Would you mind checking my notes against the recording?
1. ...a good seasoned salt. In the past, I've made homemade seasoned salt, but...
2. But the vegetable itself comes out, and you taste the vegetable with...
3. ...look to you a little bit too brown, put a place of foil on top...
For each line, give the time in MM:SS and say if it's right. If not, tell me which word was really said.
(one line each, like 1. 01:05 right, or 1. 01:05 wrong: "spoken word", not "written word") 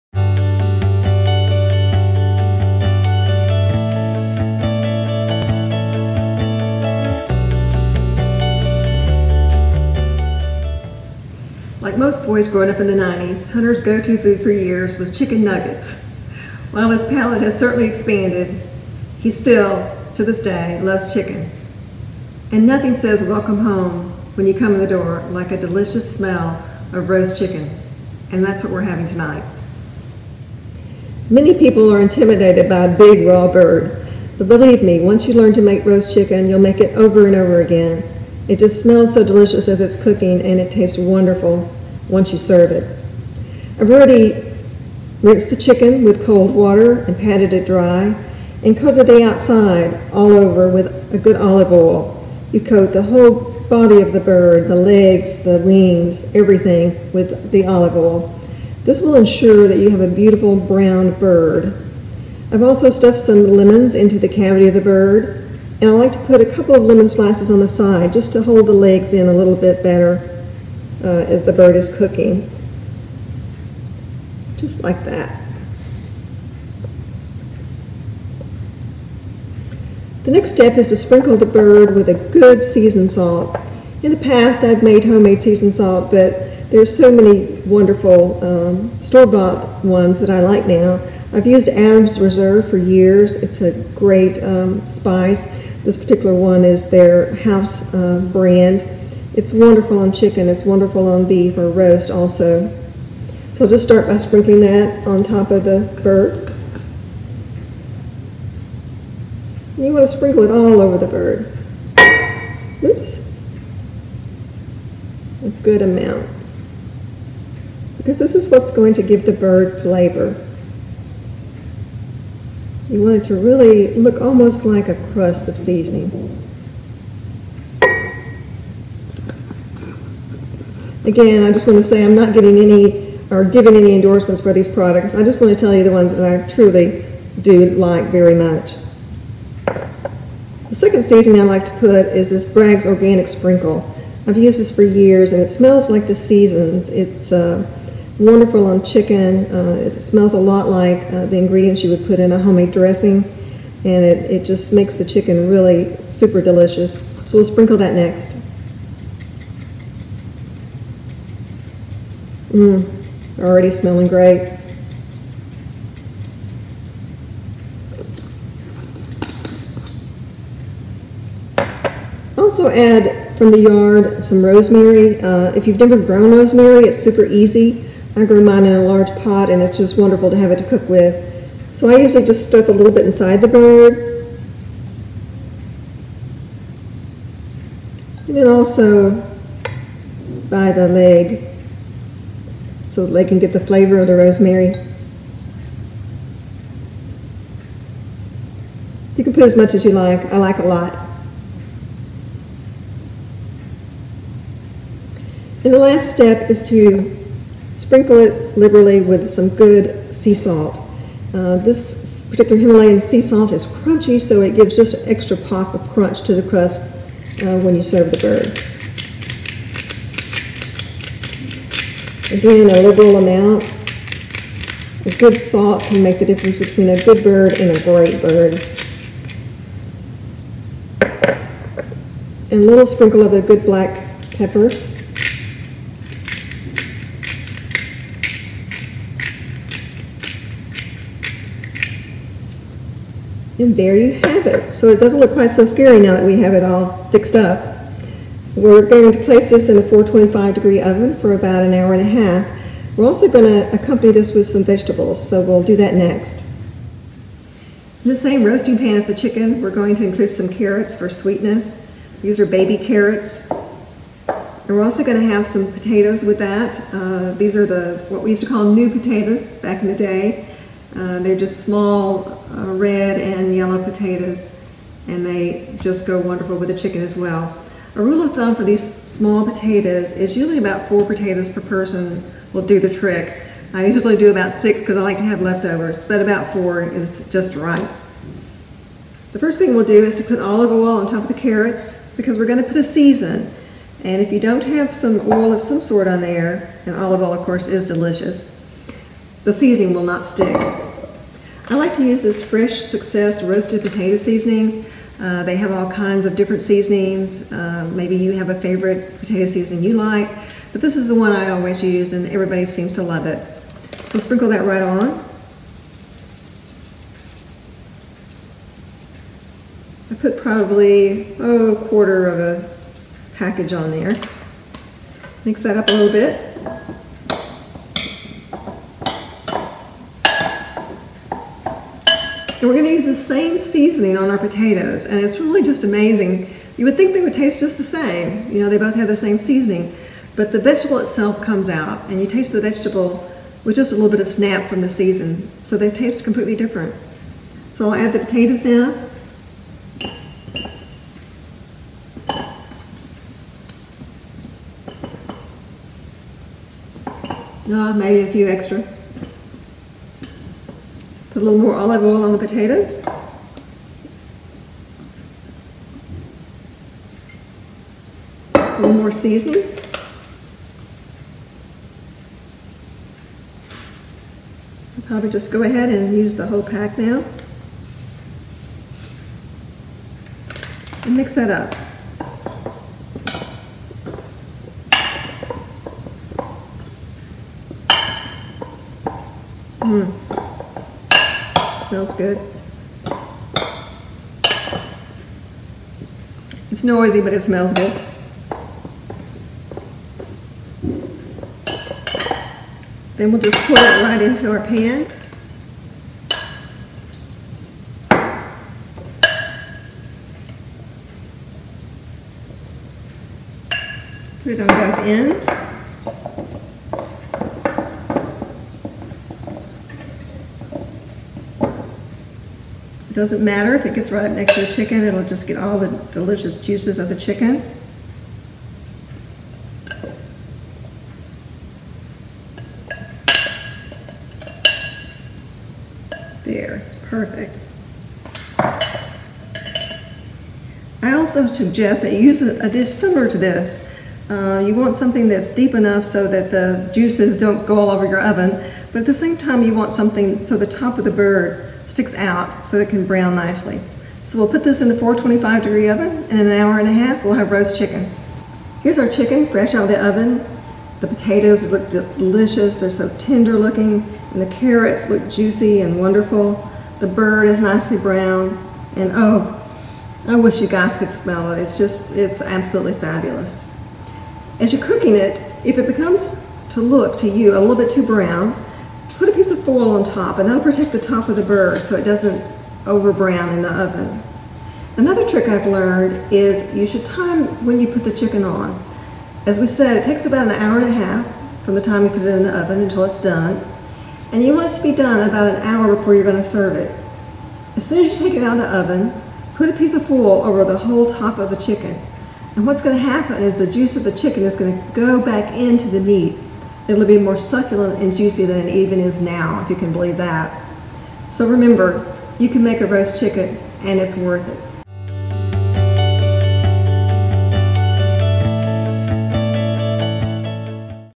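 1. 01:22 right
2. 05:40 right
3. 07:56 wrong: "piece", not "place".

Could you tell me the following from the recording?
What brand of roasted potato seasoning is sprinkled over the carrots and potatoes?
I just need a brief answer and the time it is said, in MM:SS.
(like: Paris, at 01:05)
Fresh Success, at 05:02.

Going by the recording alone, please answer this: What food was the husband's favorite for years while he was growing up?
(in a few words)
chicken nuggets.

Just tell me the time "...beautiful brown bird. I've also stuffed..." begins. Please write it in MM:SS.
01:00.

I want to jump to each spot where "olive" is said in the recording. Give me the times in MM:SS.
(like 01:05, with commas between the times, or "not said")
00:51, 00:57, 04:50, 04:56, 06:01.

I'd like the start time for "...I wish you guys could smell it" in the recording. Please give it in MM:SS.
07:50.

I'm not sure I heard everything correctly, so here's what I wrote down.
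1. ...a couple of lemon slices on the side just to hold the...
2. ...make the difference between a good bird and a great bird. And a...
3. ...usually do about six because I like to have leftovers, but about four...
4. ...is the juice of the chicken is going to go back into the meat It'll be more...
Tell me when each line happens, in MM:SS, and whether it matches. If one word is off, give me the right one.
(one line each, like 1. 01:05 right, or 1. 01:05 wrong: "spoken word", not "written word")
1. 01:06 right
2. 03:46 right
3. 04:43 right
4. 08:23 right.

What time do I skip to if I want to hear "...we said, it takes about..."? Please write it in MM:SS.
08:09.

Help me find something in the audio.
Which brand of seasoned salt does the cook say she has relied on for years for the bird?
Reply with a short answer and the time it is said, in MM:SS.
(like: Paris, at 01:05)
Adams Reserve, at 01:31.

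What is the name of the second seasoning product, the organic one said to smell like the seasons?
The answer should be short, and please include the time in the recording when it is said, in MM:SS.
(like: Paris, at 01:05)
Bragg's Organic Sprinkle, at 02:22.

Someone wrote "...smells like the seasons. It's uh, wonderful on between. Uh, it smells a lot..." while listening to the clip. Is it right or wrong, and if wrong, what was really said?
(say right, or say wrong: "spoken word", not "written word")
wrong: "chicken", not "between".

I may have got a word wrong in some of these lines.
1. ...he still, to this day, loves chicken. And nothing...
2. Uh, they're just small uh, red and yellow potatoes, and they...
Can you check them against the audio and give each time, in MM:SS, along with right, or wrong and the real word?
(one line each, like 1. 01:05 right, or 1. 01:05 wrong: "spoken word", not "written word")
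1. 00:19 right
2. 04:30 right.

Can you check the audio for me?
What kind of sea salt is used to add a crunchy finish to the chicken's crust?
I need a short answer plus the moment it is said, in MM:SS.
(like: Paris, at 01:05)
Himalayan, at 03:32.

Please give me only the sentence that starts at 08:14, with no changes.
And you want it to be done about an hour before you're going to serve it.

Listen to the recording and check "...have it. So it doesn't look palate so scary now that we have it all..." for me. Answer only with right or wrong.
wrong.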